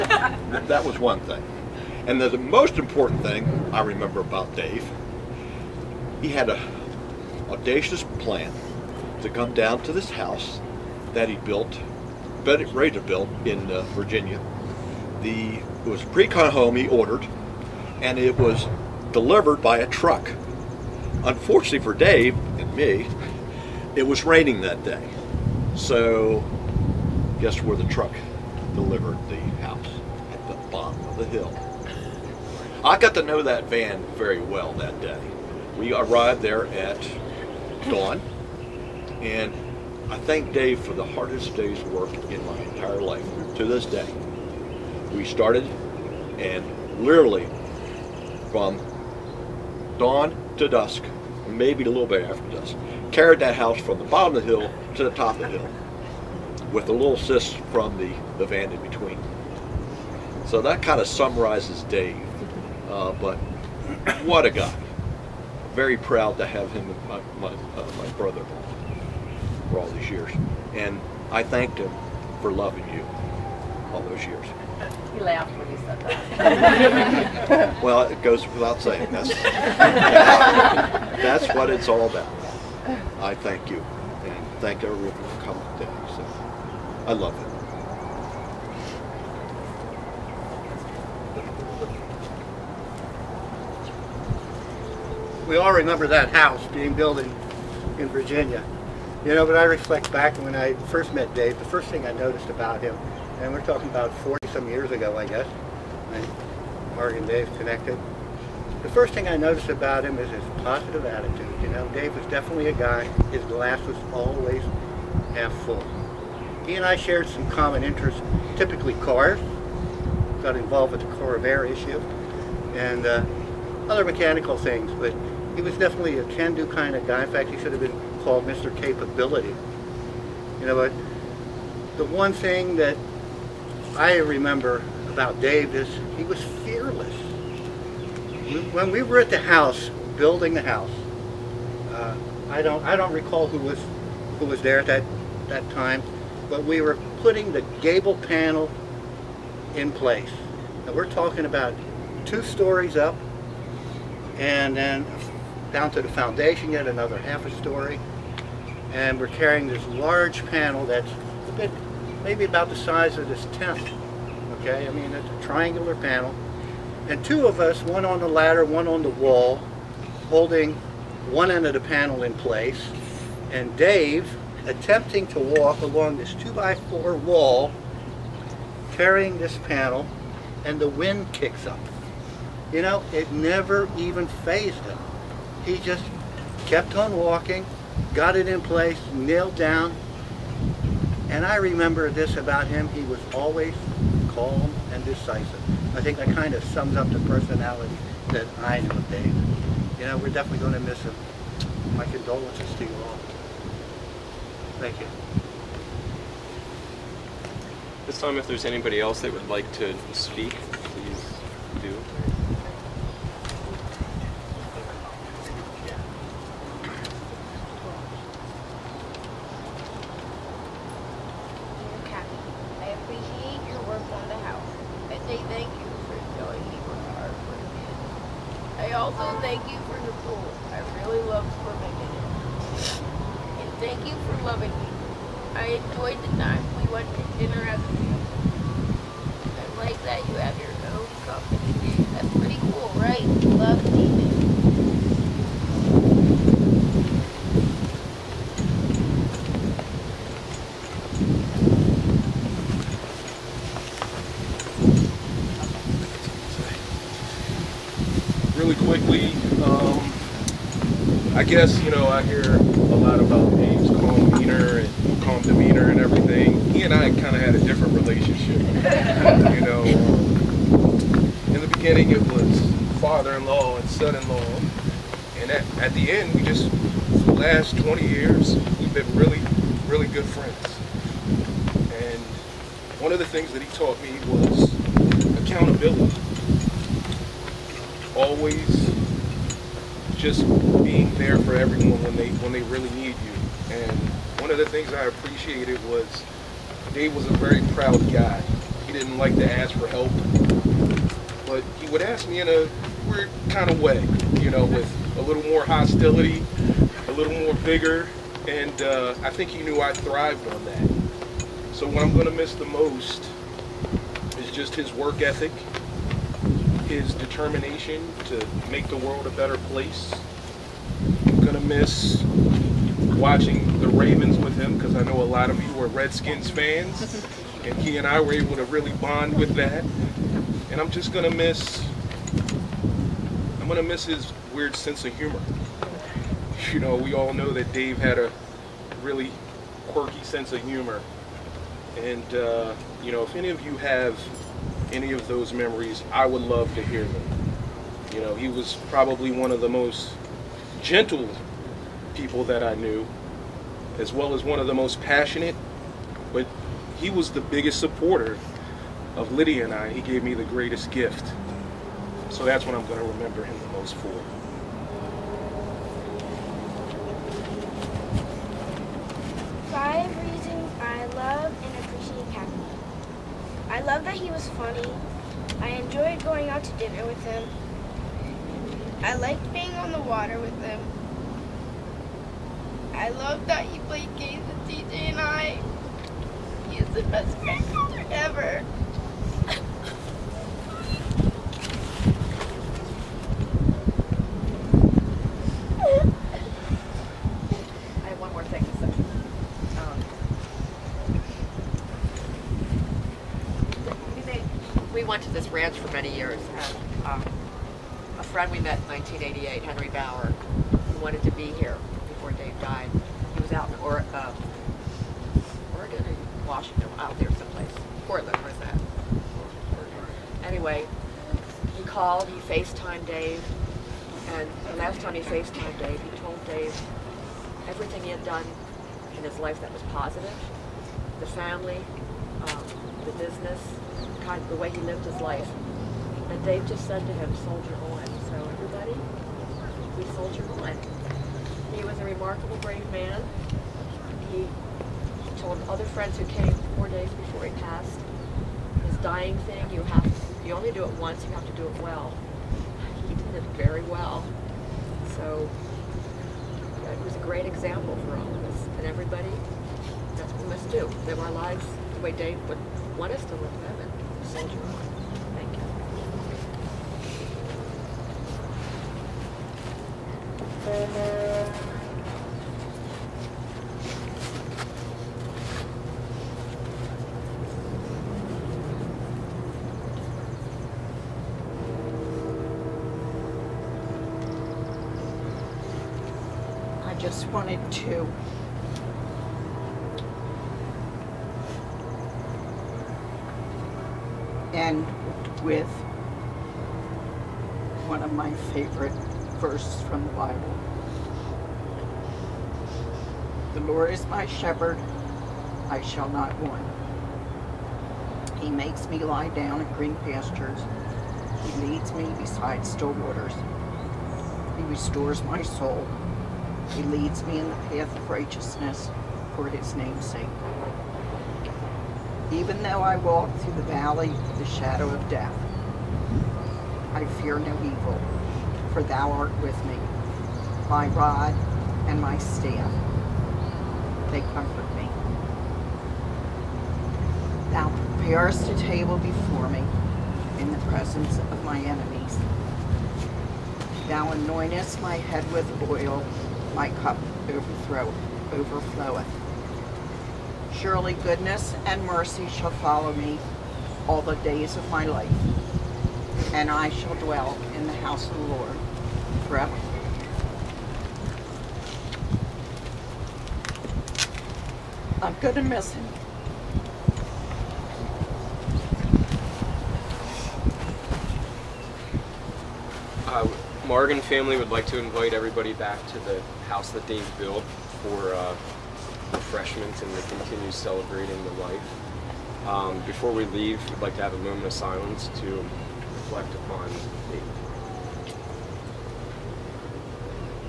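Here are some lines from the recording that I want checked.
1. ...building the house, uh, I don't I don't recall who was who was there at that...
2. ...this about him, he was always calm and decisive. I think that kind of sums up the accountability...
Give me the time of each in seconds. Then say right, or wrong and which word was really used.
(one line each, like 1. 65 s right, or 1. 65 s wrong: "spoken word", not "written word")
1. 140 s right
2. 192 s wrong: "personality", not "accountability".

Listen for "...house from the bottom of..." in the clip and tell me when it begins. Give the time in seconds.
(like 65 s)
53 s.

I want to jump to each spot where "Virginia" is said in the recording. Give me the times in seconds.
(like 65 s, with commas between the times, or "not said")
13 s, 98 s.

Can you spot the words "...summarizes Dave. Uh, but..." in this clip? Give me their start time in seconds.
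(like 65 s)
61 s.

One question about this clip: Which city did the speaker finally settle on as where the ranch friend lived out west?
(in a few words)
Portland.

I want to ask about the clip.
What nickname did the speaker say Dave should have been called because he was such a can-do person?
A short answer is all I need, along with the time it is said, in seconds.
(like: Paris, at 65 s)
Mr. Capability, at 128 s.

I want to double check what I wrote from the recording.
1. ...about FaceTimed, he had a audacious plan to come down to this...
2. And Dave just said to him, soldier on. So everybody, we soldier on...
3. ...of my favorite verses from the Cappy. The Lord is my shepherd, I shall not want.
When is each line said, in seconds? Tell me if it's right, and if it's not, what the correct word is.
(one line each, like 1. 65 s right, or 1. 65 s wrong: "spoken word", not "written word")
1. 4 s wrong: "Dave", not "FaceTimed"
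2. 436 s right
3. 498 s wrong: "Bible", not "Cappy".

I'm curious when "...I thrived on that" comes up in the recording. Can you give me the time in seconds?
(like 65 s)
309 s.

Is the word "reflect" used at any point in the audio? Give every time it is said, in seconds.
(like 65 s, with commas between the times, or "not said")
99 s, 585 s.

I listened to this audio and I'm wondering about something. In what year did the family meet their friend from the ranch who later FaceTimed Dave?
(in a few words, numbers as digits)
1988.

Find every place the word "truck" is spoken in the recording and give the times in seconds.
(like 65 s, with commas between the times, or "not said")
19 s, 27 s.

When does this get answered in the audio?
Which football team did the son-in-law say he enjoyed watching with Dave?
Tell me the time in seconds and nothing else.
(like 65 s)
323 s.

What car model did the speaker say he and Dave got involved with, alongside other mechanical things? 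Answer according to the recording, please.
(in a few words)
Corvair.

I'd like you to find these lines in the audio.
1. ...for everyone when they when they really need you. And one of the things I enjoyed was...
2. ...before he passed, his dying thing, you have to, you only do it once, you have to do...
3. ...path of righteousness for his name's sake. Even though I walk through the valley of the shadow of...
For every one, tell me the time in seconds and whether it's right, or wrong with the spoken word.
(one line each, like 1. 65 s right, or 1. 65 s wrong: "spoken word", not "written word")
1. 291 s wrong: "appreciated", not "enjoyed"
2. 447 s right
3. 517 s right.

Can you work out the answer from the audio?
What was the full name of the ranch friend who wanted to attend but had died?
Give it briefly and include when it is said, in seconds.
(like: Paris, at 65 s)
Henry Bauer, at 409 s.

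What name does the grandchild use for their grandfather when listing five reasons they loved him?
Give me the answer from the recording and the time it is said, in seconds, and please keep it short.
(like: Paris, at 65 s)
Cappy, at 372 s.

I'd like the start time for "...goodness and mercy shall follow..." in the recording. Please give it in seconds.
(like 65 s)
550 s.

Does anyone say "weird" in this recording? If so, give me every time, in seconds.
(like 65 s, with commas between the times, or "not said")
303 s, 334 s.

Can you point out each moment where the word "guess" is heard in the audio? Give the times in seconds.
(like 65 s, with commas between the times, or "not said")
27 s, 105 s, 261 s.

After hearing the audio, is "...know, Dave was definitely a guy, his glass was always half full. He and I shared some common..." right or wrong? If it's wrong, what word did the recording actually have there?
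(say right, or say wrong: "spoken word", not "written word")
right.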